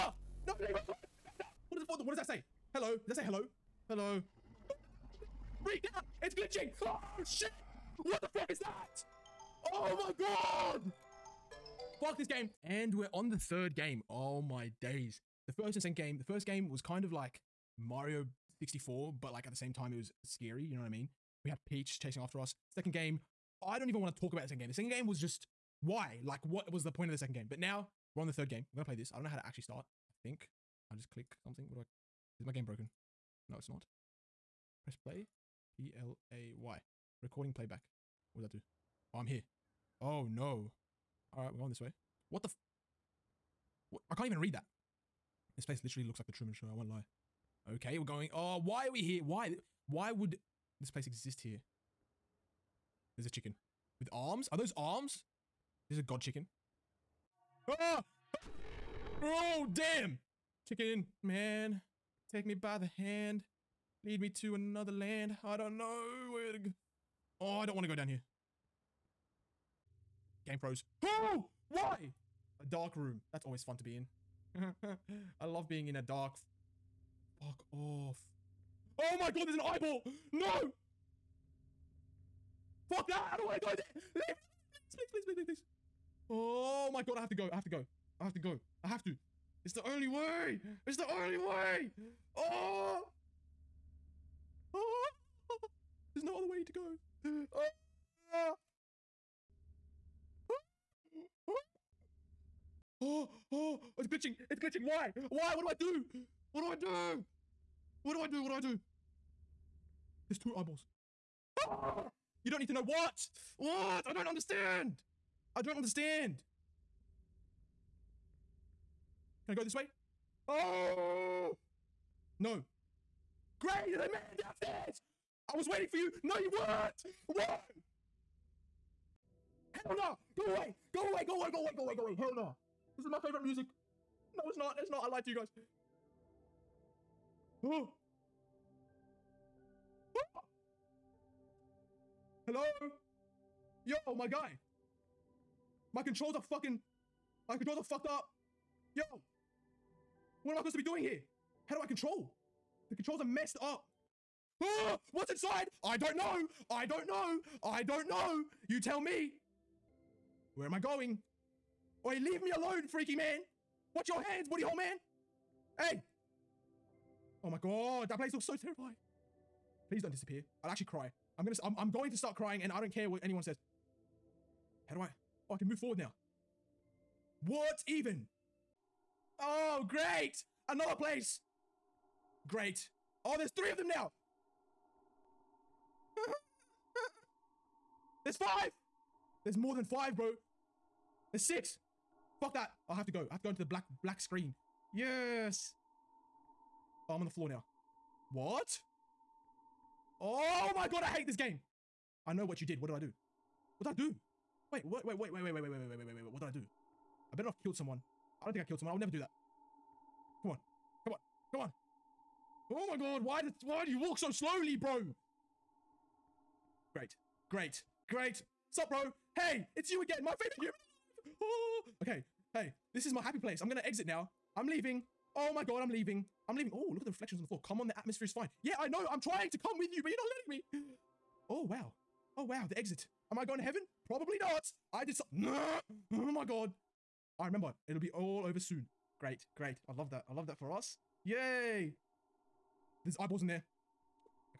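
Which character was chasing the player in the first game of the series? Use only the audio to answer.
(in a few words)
Peach.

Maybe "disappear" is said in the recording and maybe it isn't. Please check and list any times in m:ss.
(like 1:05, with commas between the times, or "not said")
2:50.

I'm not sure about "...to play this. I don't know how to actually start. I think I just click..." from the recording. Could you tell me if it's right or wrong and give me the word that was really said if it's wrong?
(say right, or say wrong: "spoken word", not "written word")
right.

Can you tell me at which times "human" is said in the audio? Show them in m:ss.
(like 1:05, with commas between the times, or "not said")
3:40.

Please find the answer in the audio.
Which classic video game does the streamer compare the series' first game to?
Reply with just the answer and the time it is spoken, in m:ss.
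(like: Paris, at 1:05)
Mario 64, at 0:17.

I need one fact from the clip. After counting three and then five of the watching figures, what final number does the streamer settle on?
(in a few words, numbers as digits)
6.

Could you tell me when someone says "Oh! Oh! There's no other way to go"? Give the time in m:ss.
1:32.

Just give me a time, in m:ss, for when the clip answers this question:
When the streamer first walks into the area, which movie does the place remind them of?
0:46.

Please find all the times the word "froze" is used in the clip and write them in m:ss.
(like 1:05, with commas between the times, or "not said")
1:10.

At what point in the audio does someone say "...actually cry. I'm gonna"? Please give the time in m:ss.
2:50.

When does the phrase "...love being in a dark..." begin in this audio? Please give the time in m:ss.
1:15.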